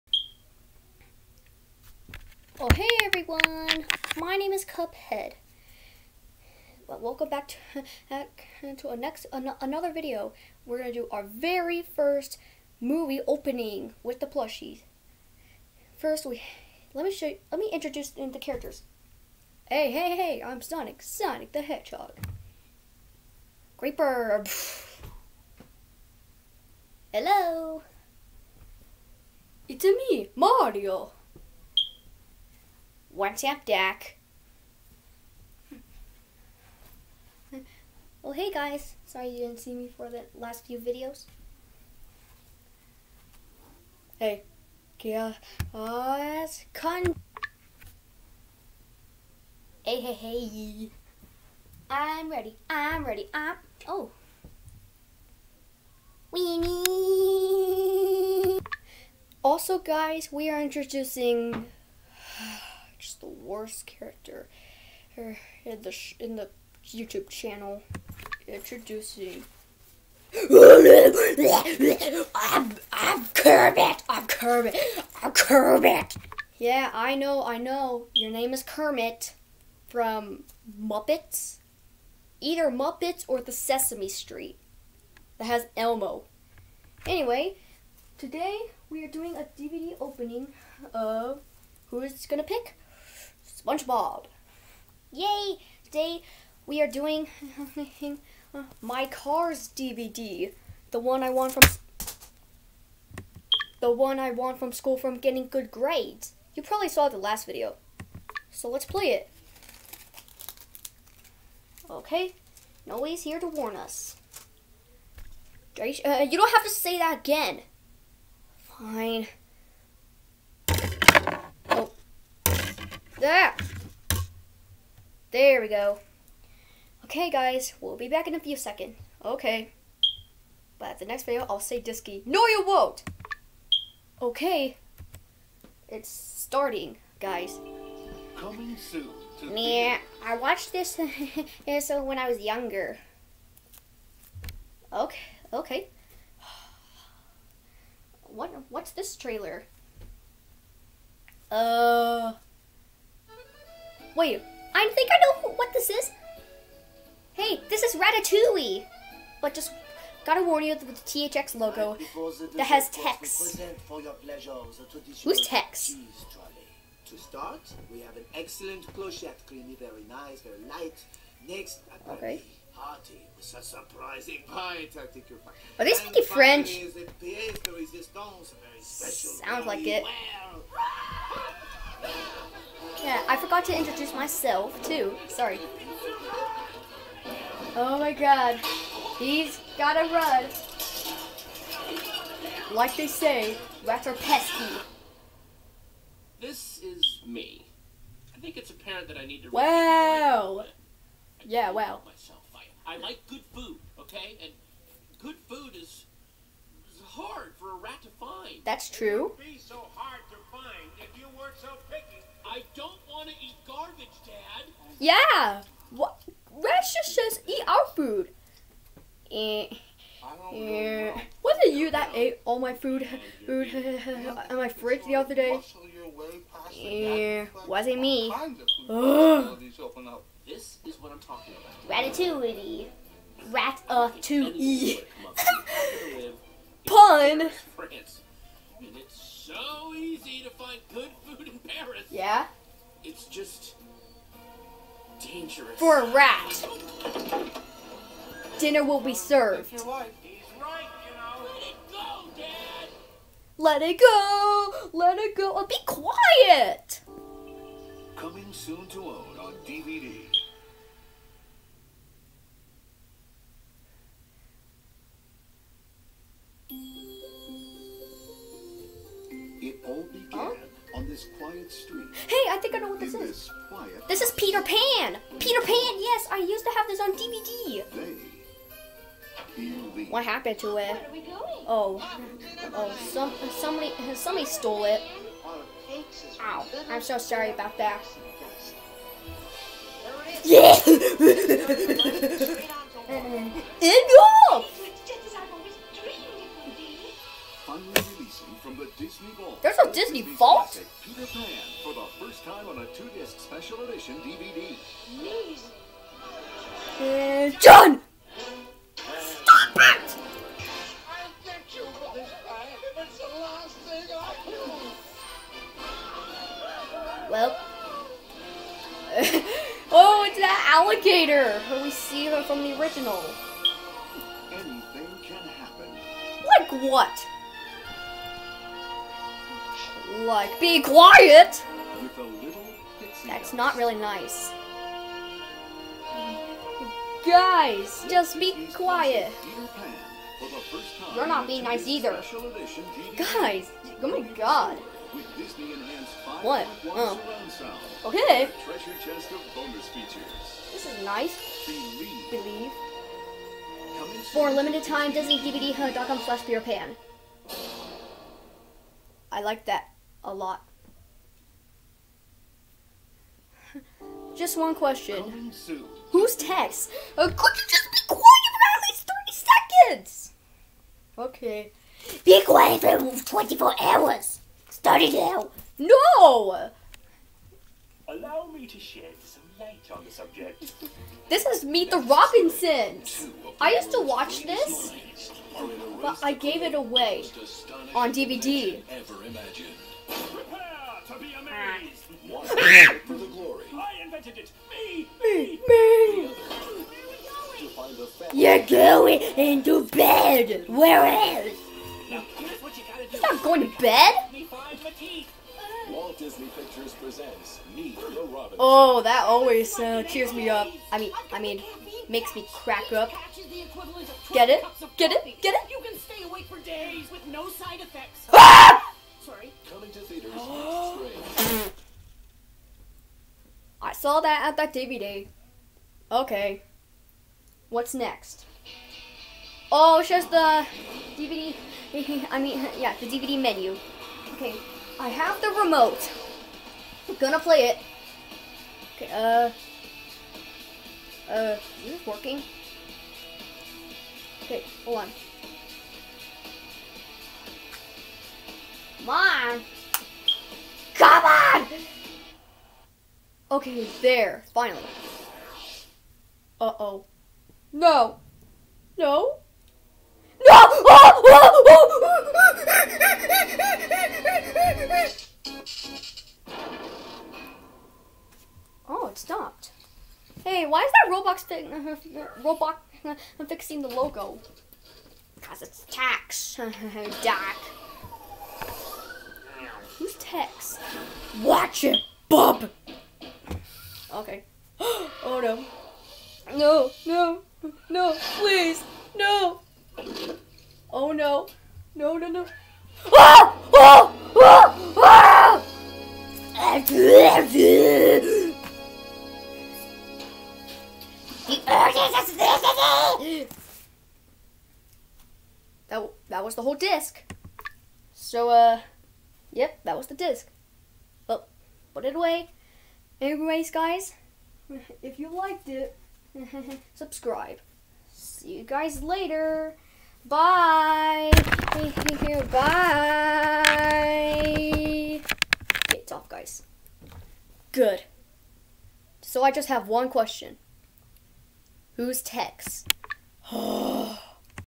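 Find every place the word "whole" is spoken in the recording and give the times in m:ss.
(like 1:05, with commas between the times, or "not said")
8:26.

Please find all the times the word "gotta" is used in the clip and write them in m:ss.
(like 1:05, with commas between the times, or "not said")
2:40, 3:09, 6:42.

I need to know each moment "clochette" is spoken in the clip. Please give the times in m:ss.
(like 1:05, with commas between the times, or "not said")
2:48.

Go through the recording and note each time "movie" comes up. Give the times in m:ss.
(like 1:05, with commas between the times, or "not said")
0:12.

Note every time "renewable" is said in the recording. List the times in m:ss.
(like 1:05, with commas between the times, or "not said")
not said.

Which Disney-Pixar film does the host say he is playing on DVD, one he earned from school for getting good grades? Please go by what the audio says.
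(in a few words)
Cars.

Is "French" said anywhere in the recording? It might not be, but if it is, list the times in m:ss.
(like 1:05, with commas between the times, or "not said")
2:56.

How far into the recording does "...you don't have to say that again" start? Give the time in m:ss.
1:56.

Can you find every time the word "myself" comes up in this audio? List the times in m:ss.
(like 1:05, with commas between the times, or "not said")
3:04, 3:22.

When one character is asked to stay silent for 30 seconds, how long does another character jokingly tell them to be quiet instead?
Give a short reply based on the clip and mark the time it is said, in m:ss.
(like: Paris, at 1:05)
24 hours, at 6:13.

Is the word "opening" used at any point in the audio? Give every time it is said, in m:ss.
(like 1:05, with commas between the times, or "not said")
0:13, 1:30.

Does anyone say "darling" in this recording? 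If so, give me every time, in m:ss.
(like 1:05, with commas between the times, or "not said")
not said.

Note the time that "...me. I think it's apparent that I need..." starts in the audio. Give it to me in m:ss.
3:17.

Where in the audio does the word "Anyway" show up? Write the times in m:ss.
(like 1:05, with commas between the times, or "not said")
1:27, 8:33.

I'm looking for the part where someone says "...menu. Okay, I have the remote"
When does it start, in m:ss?
7:13.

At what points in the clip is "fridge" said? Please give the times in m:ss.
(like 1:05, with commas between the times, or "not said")
3:44.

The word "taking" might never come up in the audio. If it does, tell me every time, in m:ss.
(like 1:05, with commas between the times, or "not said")
not said.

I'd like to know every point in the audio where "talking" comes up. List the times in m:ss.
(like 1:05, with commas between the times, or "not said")
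3:51.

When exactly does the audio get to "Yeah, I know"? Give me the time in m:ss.
1:16.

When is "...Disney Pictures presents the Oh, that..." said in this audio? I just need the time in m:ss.
6:46.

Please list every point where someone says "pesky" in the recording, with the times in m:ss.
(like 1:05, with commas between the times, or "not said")
3:14.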